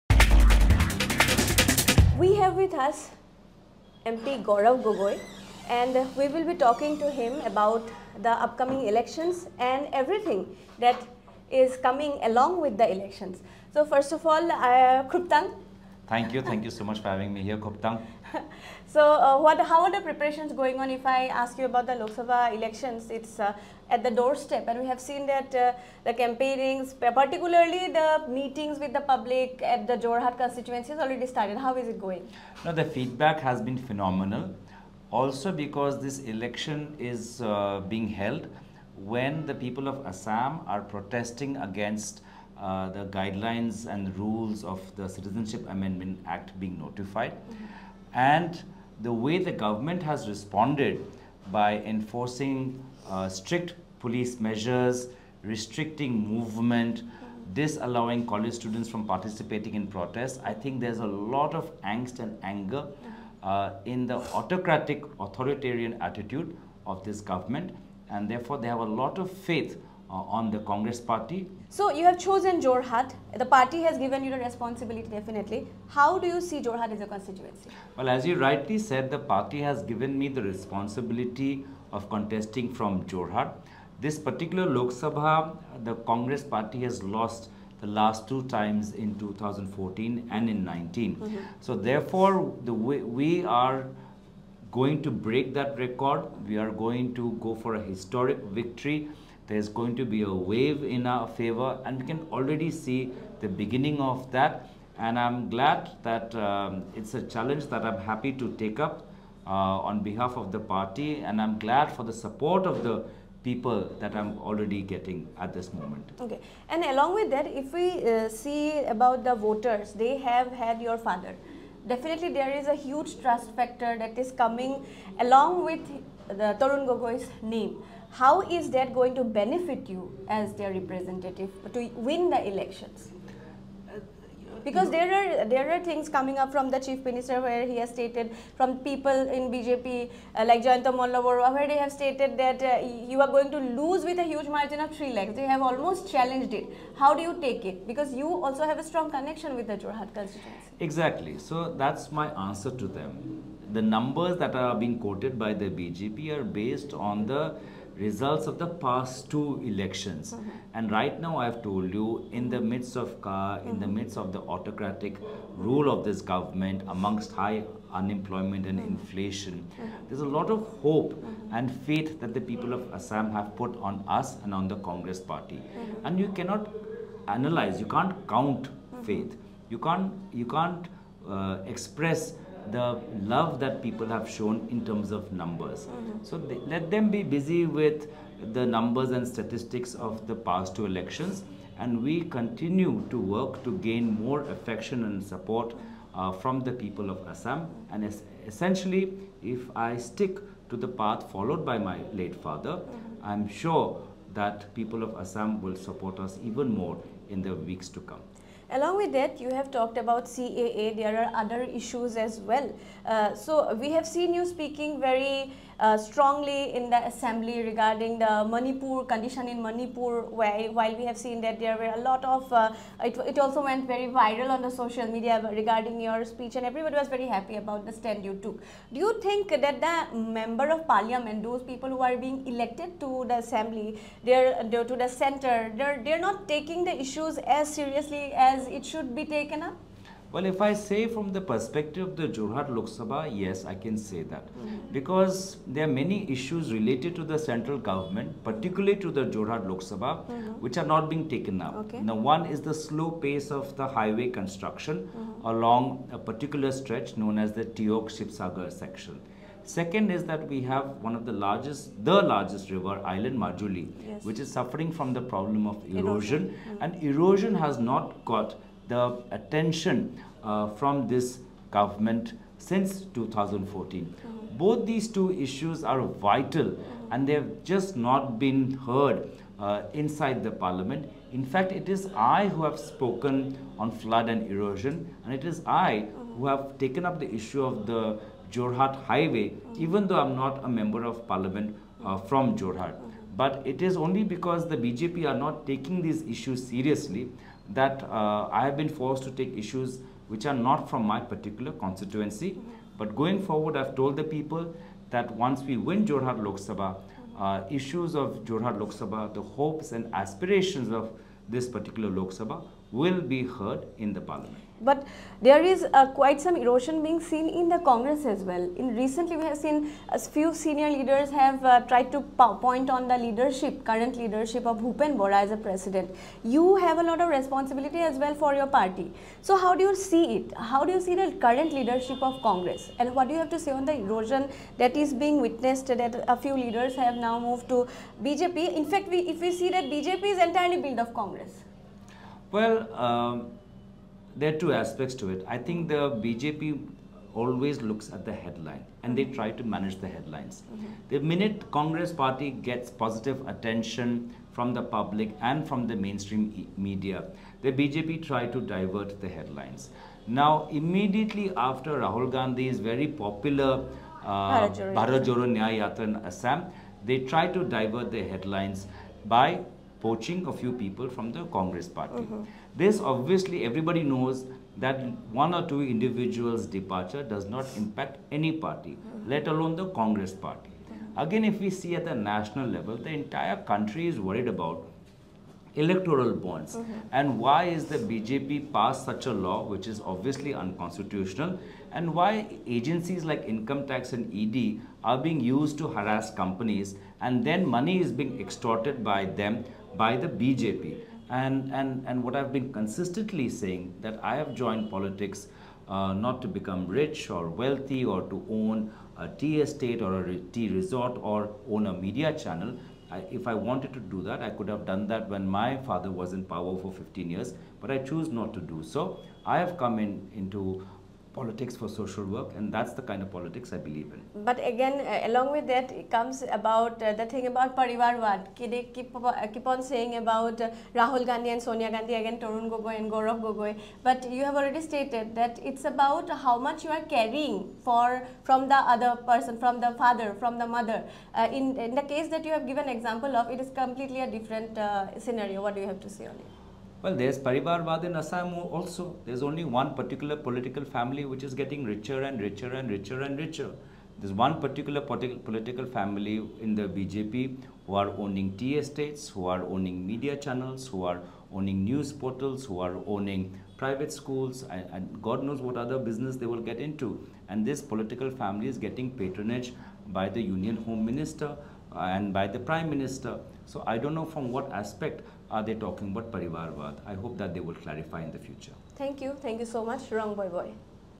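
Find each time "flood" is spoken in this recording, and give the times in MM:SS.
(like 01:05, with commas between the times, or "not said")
04:43.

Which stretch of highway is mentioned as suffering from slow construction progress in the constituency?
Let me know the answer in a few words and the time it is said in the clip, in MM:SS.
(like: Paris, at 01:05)
Teok Sibsagar section, at 04:17.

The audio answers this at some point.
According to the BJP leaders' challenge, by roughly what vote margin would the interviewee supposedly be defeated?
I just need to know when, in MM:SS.
02:24.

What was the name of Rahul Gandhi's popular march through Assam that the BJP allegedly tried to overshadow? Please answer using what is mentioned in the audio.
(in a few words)
Bharat Nyaya Yatra.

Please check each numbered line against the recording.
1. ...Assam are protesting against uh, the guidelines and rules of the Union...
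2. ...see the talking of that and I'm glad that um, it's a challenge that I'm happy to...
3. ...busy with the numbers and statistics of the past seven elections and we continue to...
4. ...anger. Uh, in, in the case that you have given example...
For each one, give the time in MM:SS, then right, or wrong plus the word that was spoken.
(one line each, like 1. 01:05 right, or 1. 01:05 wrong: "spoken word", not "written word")
1. 00:40 wrong: "Citizenship", not "Union"
2. 01:42 wrong: "beginning", not "talking"
3. 03:07 wrong: "two", not "seven"
4. 07:20 wrong: "mother", not "anger".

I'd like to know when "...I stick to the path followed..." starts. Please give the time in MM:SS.
03:19.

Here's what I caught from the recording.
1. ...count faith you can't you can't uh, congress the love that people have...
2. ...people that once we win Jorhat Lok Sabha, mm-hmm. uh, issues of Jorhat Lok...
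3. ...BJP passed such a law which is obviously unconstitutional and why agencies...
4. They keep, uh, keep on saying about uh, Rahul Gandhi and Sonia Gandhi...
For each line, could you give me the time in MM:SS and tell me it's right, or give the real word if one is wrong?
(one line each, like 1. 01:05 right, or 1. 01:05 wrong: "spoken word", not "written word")
1. 02:58 wrong: "express", not "congress"
2. 05:04 right
3. 06:28 right
4. 07:08 right.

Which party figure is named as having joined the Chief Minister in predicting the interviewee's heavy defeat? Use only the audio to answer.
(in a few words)
Jayanta Malla Baruah.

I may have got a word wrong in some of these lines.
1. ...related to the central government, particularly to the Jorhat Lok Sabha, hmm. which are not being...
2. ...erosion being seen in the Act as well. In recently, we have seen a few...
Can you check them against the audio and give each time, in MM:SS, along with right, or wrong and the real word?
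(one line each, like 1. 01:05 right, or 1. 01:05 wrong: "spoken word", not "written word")
1. 04:06 right
2. 05:16 wrong: "Congress", not "Act".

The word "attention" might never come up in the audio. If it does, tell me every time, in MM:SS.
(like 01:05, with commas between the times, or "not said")
04:29, 05:53.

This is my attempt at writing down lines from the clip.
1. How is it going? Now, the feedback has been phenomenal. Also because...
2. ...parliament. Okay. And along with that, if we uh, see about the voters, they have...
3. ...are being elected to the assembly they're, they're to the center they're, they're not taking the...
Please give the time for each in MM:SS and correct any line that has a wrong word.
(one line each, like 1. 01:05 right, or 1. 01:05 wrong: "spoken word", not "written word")
1. 00:31 right
2. 01:55 wrong: "moment", not "parliament"
3. 03:51 right.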